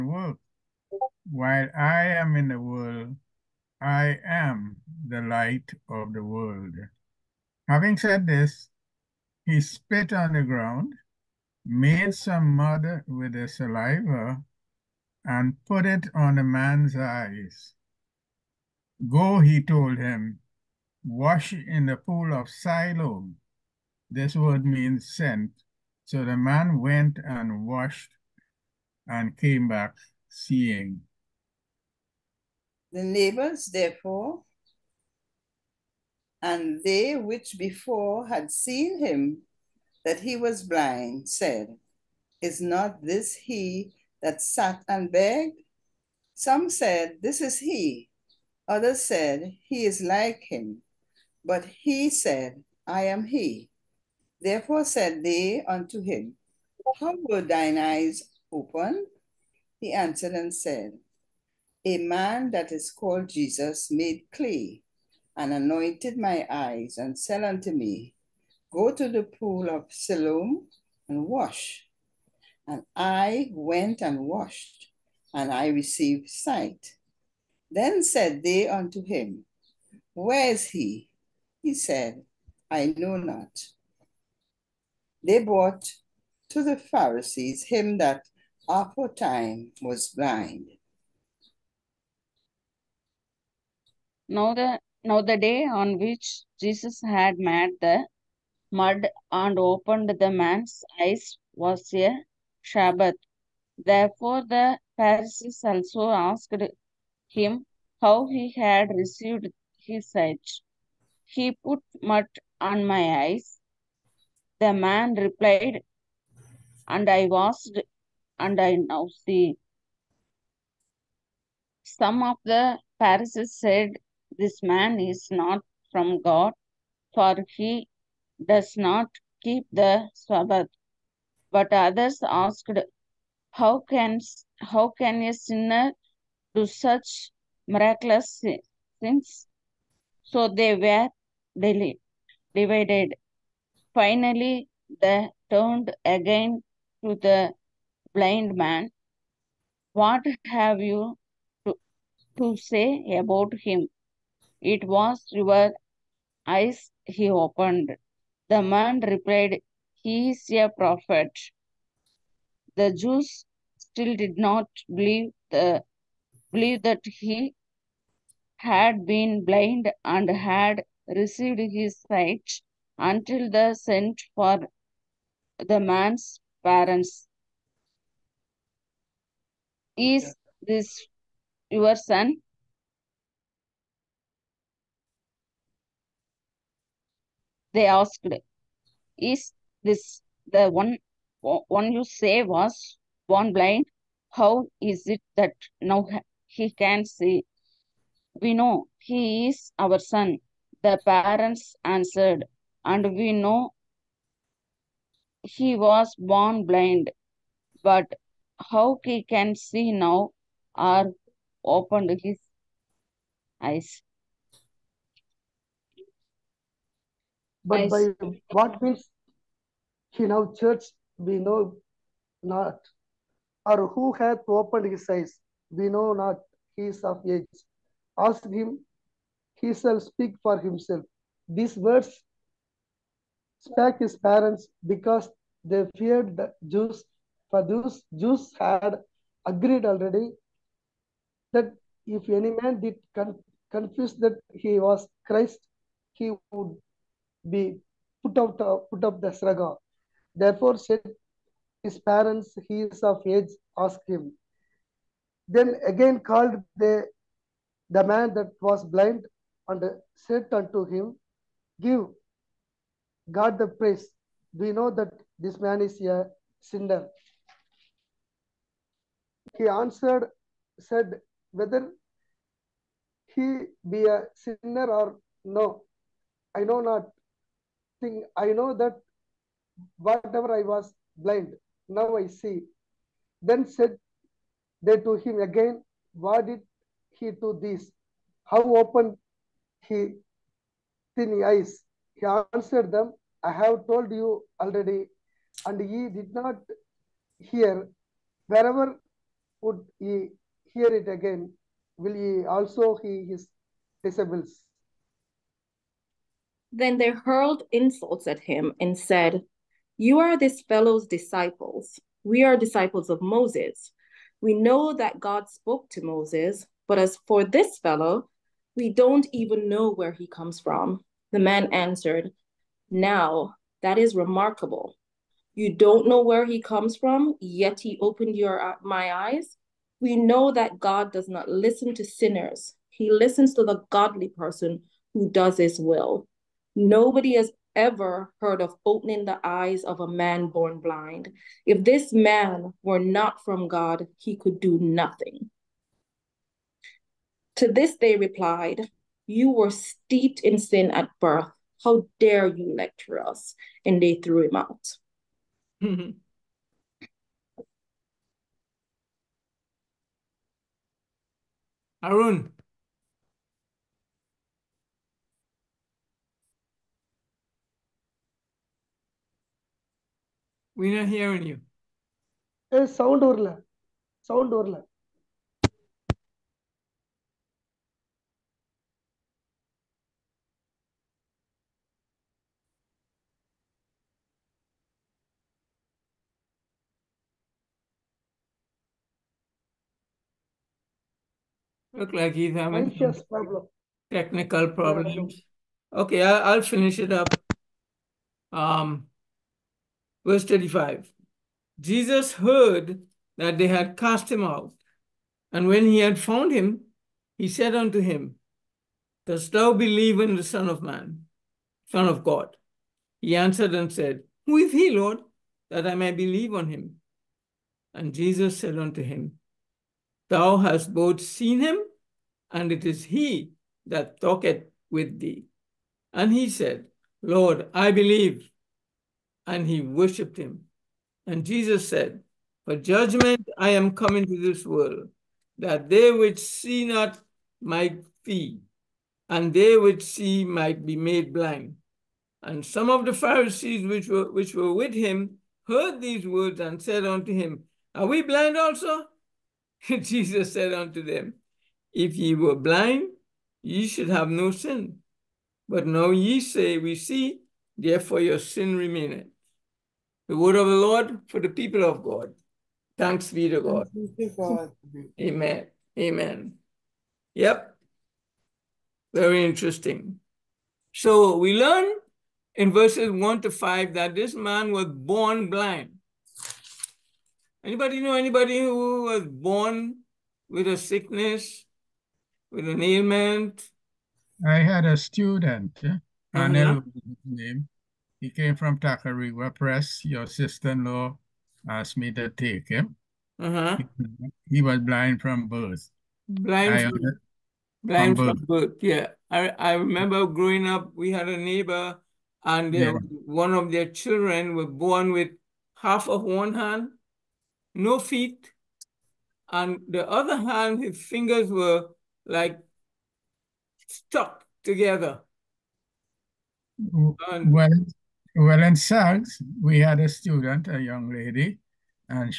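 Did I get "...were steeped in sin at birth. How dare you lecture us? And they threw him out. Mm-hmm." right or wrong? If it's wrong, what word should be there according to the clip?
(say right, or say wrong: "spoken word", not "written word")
right.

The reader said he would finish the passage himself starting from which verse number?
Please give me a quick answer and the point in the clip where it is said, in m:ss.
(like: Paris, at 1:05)
35, at 6:40.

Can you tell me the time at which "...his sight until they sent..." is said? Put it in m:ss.
2:51.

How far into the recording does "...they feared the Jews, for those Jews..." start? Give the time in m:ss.
3:55.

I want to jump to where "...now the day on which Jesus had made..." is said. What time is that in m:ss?
1:35.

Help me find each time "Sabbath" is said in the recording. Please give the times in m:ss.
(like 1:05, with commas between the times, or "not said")
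1:42, 2:10.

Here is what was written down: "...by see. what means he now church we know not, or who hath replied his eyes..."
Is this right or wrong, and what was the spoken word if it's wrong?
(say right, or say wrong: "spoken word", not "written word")
wrong: "opened", not "replied".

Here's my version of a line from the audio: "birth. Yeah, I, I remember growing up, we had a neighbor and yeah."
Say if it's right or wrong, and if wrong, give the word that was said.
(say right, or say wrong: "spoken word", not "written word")
right.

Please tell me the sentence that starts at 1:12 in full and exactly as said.
And I went and washed, and I received sight.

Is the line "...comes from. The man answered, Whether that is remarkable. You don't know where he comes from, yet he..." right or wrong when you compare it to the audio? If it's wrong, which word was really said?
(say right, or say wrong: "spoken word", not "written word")
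wrong: "Now", not "Whether".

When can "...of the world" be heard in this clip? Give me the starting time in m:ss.
0:05.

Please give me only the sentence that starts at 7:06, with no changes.
And he said, Lord, I believe and he worshiped him.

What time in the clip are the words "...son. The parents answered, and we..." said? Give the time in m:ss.
3:20.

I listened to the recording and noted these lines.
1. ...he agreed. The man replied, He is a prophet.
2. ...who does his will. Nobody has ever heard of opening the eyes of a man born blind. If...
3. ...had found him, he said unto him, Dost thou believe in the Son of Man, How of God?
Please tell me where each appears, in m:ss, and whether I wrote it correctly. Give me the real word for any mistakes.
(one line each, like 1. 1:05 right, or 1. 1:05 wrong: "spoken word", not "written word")
1. 2:37 wrong: "opened", not "agreed"
2. 5:35 right
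3. 6:46 wrong: "Son", not "How".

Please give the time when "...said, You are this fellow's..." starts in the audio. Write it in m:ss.
5:08.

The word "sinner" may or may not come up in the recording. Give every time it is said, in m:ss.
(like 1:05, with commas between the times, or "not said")
2:15, 4:26, 4:34, 5:32.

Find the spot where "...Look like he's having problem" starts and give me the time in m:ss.
6:32.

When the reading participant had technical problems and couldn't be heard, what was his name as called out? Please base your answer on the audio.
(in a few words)
Arun.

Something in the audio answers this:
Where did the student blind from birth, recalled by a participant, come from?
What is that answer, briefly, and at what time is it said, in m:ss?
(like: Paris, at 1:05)
Tacarigua, at 8:08.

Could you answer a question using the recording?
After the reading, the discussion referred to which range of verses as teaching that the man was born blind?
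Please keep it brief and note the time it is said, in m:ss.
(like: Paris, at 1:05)
1 to 5, at 7:52.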